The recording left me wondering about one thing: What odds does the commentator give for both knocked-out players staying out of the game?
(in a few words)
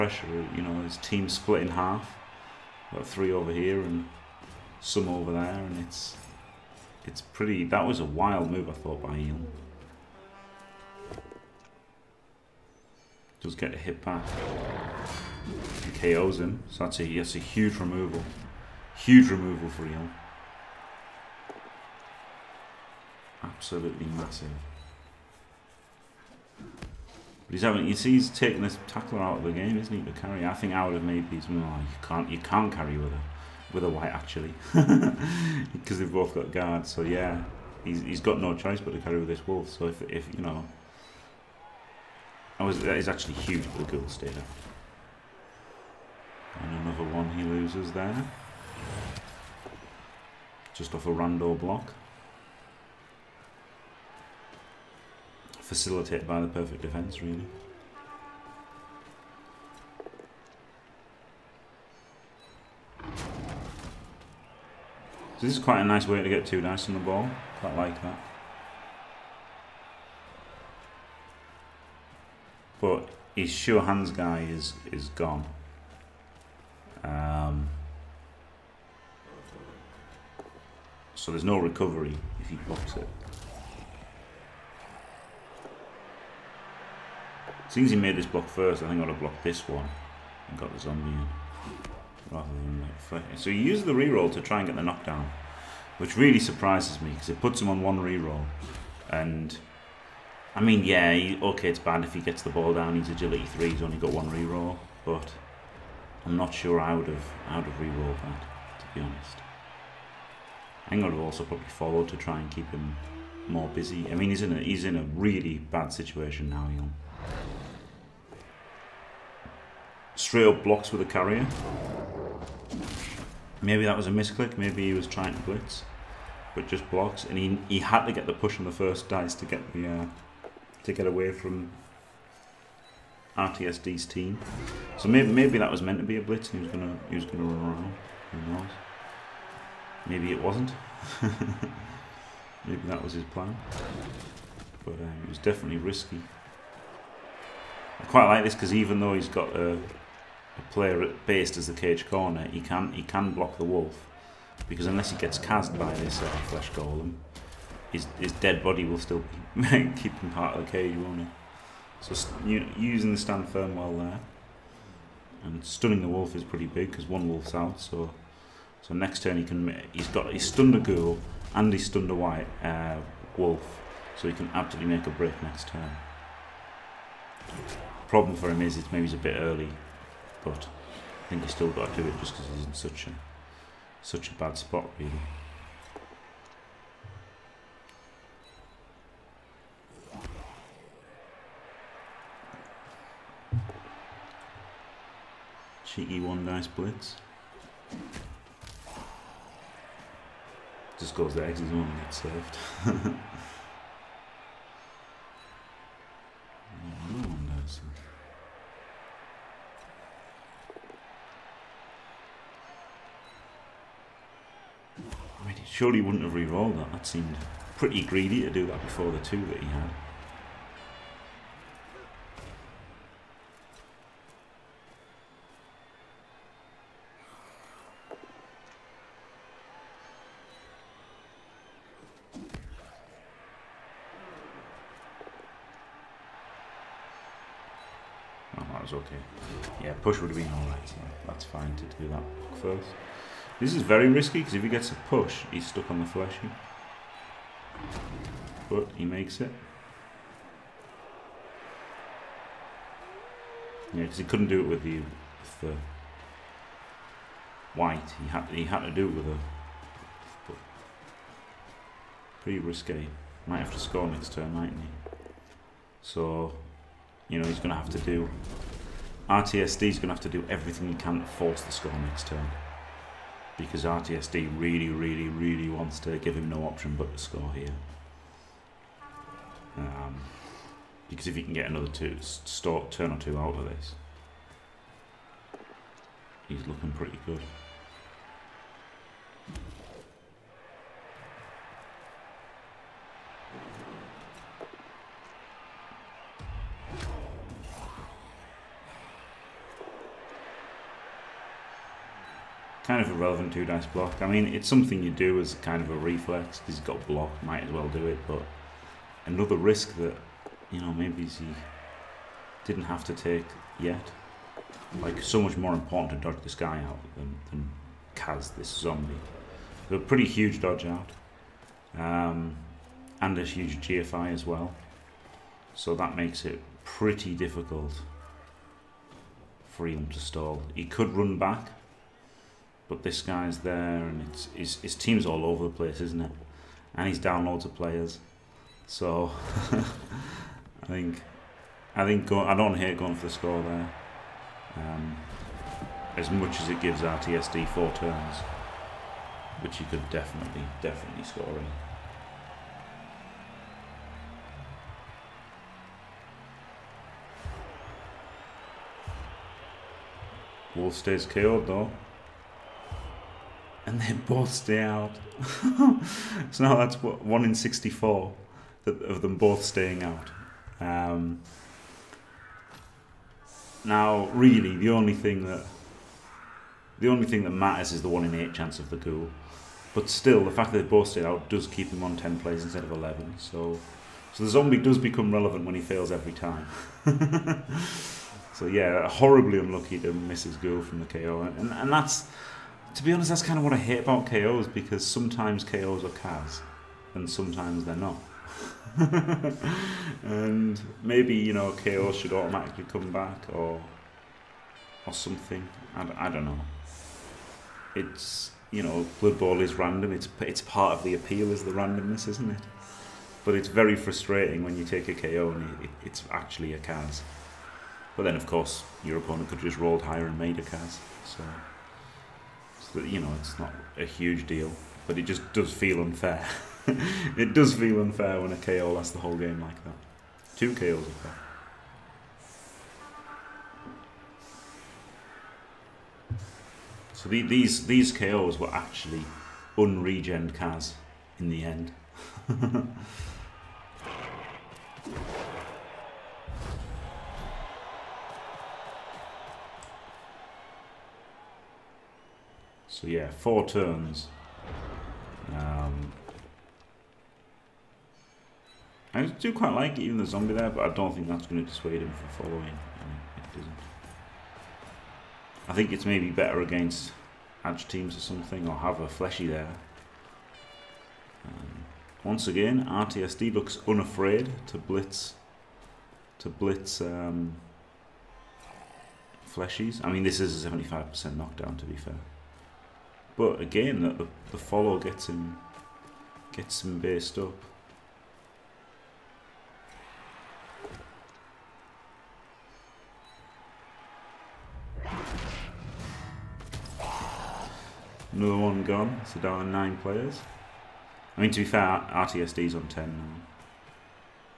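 1 in 64.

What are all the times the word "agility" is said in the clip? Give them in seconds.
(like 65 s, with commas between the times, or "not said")
103 s.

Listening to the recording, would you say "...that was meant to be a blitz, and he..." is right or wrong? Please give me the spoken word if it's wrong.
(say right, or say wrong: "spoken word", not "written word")
right.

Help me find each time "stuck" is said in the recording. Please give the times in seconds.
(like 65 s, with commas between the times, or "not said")
245 s.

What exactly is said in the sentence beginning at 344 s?
Um, as much as it gives RTSD four turns, which you could definitely definitely score in.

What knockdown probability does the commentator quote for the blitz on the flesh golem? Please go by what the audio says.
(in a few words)
75%.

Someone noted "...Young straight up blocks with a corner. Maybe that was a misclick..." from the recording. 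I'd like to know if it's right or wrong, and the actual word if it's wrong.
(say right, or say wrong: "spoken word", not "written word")
wrong: "carrier", not "corner".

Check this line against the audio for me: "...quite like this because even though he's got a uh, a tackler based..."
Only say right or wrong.
wrong.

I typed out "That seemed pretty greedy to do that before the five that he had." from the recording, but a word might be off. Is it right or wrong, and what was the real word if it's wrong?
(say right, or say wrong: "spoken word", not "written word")
wrong: "two", not "five".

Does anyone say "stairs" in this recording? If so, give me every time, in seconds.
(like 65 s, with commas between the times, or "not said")
not said.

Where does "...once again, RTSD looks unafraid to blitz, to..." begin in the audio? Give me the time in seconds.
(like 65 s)
472 s.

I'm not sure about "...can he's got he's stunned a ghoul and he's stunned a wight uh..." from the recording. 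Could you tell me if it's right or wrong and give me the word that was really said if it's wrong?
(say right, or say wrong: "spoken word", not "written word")
right.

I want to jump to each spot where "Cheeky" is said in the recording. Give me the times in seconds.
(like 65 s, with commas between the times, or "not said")
195 s.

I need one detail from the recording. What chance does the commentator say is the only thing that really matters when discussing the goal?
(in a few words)
1 in 8.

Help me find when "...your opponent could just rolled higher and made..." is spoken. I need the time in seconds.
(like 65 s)
419 s.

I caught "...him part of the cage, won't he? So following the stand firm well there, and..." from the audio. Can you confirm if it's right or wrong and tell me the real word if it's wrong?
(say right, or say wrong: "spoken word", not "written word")
wrong: "using", not "following".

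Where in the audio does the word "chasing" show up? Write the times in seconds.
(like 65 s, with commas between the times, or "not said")
not said.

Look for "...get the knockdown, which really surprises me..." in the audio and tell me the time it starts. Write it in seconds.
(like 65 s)
94 s.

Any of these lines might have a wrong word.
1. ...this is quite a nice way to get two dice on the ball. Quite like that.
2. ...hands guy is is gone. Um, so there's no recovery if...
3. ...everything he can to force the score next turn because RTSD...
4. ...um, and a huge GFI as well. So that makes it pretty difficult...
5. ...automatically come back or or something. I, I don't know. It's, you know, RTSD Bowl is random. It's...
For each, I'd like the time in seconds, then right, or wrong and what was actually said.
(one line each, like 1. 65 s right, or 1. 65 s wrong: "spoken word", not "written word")
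1. 65 s right
2. 73 s right
3. 270 s right
4. 321 s right
5. 402 s wrong: "Blood", not "RTSD".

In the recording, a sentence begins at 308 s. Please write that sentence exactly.
But another risk that you know maybe he didn't have to take yet.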